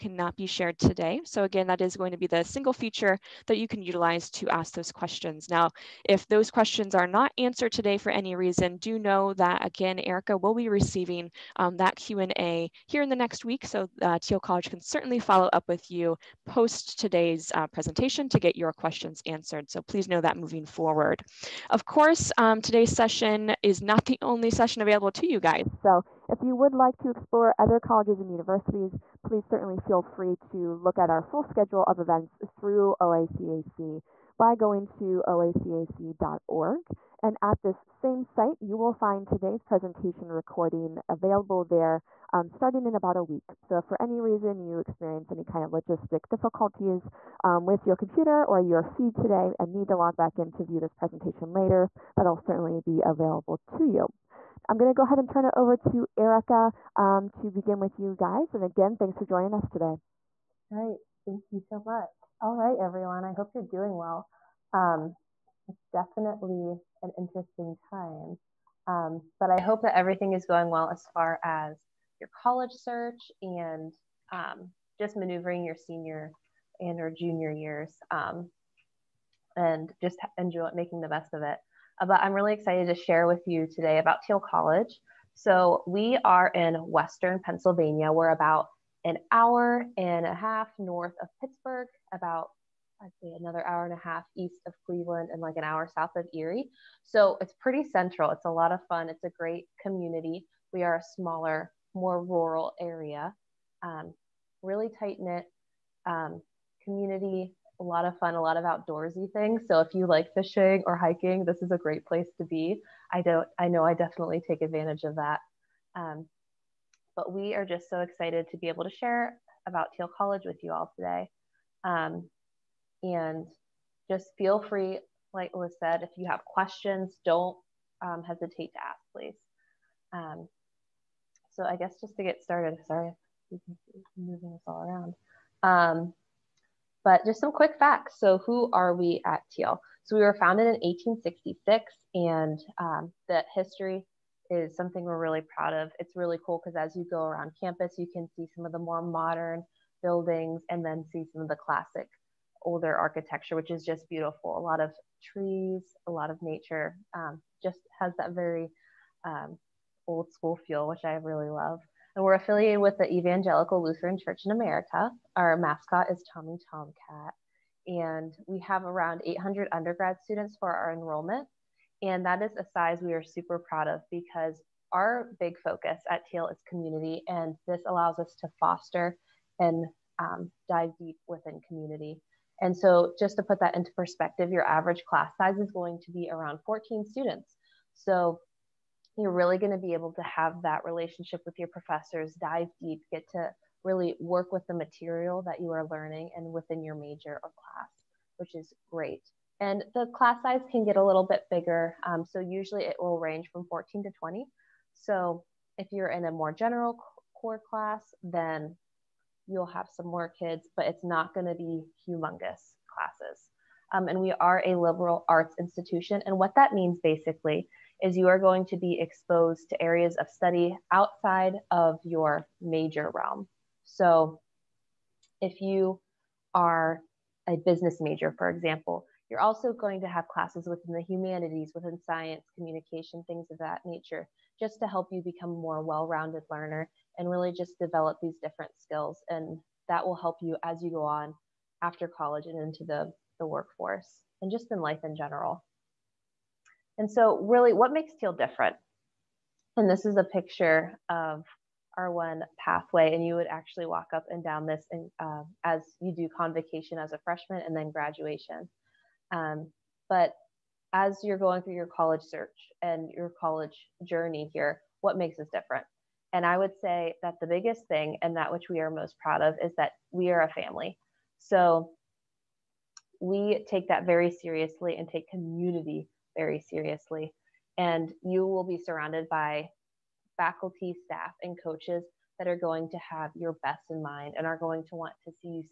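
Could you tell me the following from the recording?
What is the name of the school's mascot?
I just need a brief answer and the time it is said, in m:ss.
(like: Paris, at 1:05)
Tommy Tomcat, at 2:46.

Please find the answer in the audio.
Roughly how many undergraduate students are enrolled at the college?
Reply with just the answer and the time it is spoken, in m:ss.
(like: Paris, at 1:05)
800, at 2:49.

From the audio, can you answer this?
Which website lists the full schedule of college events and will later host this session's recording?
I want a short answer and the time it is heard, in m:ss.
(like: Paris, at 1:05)
oacac.org, at 0:35.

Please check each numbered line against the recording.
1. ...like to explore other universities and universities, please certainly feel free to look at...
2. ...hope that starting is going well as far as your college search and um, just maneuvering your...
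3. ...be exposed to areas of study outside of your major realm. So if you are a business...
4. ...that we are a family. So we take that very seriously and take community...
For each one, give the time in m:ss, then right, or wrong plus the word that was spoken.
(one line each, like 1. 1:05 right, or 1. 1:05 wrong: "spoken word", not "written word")
1. 0:26 wrong: "colleges", not "universities"
2. 1:09 wrong: "everything", not "starting"
3. 3:38 right
4. 4:29 right.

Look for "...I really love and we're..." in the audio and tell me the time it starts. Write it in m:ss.
2:41.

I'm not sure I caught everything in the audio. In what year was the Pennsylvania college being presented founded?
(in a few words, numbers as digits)
1866.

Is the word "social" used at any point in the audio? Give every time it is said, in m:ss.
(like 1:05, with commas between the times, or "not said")
not said.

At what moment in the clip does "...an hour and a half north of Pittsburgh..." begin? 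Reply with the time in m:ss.
1:29.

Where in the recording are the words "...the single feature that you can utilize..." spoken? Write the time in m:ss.
0:02.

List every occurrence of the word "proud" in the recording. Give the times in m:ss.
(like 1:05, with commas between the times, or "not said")
2:25, 2:53, 4:29.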